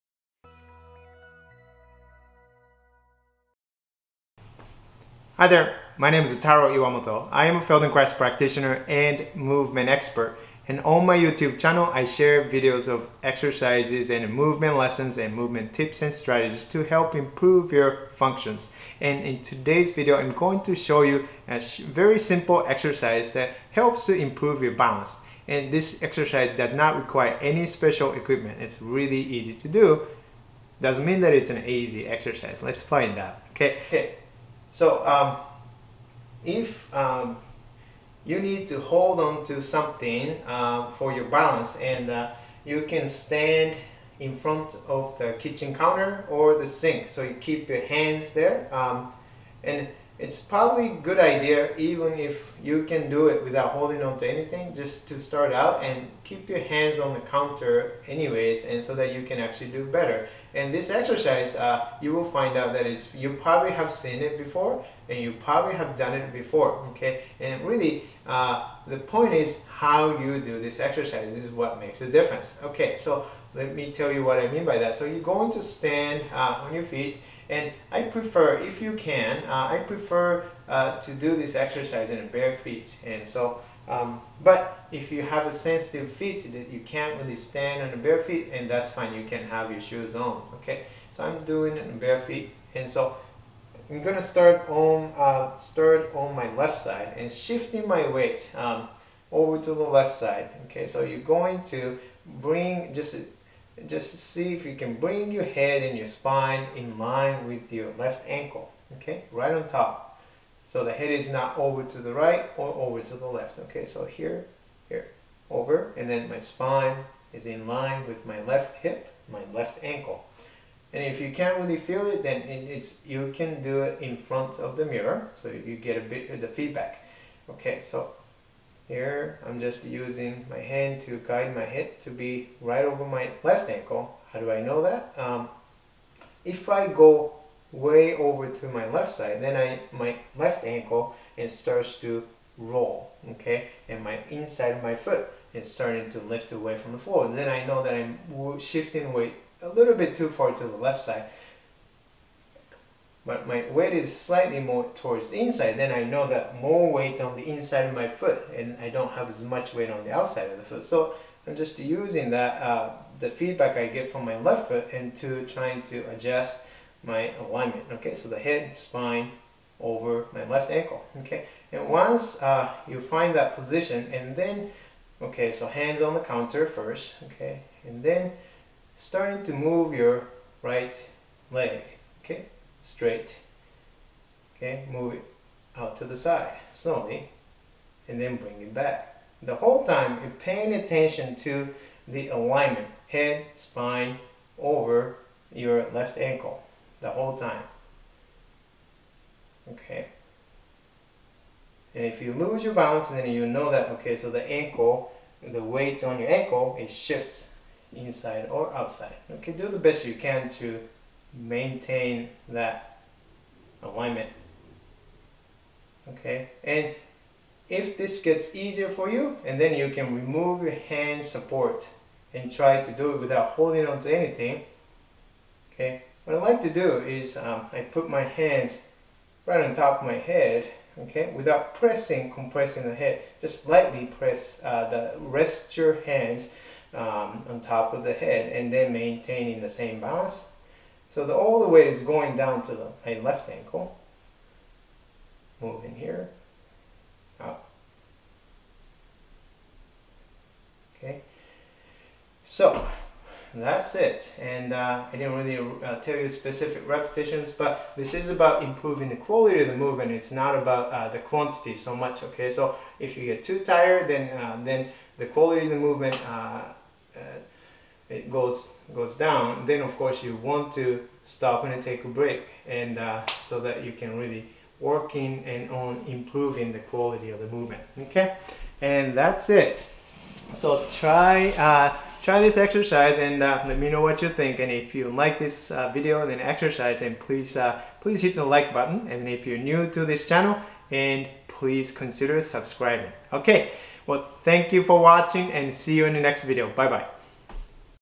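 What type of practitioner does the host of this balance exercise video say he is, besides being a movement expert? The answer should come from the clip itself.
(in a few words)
Feldenkrais.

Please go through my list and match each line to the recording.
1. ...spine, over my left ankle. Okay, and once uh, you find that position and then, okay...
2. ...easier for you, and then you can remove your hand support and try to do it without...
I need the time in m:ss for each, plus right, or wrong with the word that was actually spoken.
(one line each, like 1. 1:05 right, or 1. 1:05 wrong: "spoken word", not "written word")
1. 2:48 right
2. 3:38 right.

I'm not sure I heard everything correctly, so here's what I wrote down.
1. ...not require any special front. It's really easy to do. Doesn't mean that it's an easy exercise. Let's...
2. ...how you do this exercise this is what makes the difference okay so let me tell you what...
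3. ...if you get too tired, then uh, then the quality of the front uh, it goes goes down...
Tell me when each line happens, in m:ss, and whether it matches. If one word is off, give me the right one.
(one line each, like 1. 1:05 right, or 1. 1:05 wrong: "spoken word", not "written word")
1. 0:26 wrong: "equipment", not "front"
2. 1:09 right
3. 4:22 wrong: "movement", not "front".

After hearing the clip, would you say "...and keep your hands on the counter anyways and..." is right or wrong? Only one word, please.
right.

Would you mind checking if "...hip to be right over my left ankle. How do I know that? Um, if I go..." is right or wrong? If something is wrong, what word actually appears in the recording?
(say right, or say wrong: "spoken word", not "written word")
right.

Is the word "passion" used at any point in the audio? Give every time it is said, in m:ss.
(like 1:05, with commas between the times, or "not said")
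not said.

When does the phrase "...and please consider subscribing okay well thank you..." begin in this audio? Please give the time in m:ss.
4:50.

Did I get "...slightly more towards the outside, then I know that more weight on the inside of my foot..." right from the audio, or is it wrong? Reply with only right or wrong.
wrong.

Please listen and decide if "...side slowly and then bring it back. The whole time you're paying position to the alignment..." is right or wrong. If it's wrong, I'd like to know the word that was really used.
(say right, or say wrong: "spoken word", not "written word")
wrong: "attention", not "position".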